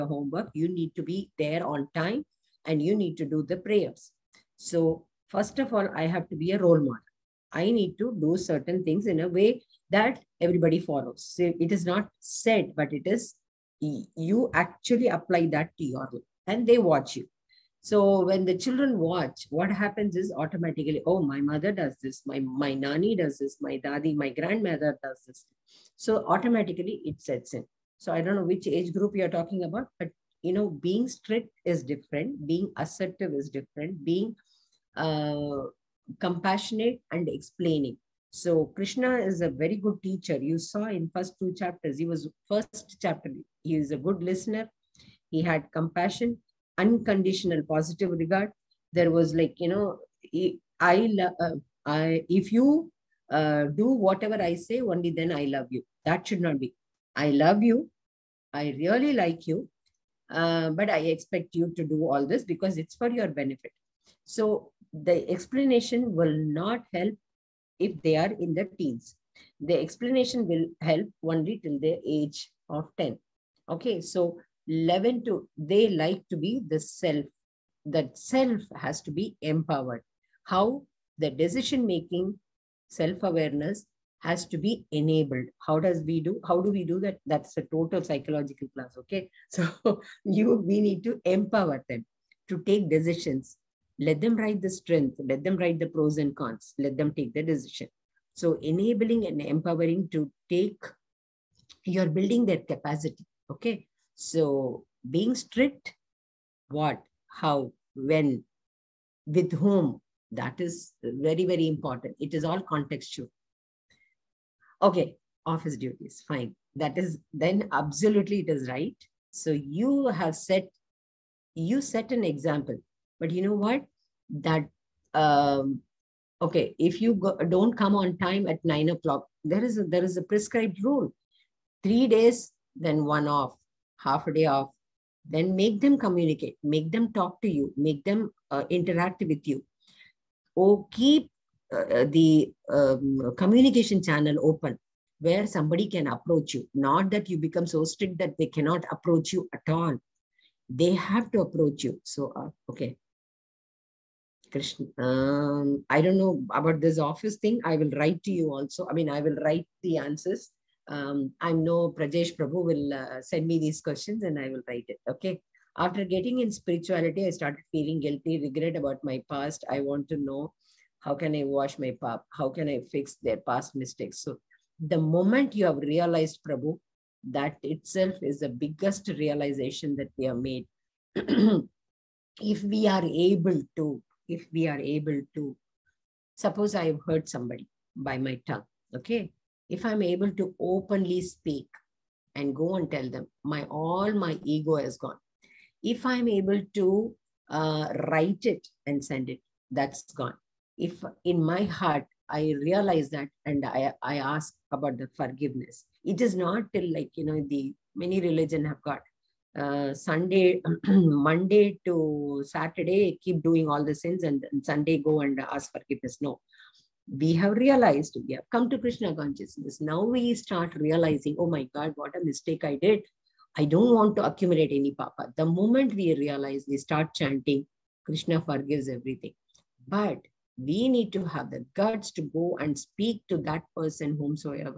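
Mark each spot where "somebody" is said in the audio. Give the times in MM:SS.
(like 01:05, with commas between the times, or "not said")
02:25, 03:07.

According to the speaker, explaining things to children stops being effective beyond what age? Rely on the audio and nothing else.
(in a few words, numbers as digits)
10.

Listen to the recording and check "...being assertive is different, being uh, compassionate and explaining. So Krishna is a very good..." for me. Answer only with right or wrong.
right.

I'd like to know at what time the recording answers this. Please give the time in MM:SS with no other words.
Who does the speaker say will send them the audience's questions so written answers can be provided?
02:41.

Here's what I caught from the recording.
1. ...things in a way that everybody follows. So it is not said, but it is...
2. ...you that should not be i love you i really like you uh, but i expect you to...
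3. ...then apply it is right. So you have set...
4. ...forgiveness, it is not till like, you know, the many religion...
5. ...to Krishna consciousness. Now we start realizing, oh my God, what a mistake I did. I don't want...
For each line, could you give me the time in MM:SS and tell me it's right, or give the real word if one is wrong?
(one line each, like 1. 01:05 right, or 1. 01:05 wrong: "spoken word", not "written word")
1. 00:08 right
2. 00:55 right
3. 01:57 wrong: "absolutely", not "apply"
4. 03:25 right
5. 03:38 right.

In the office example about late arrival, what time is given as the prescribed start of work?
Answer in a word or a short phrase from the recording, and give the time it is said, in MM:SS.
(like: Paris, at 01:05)
9 o'clock, at 02:08.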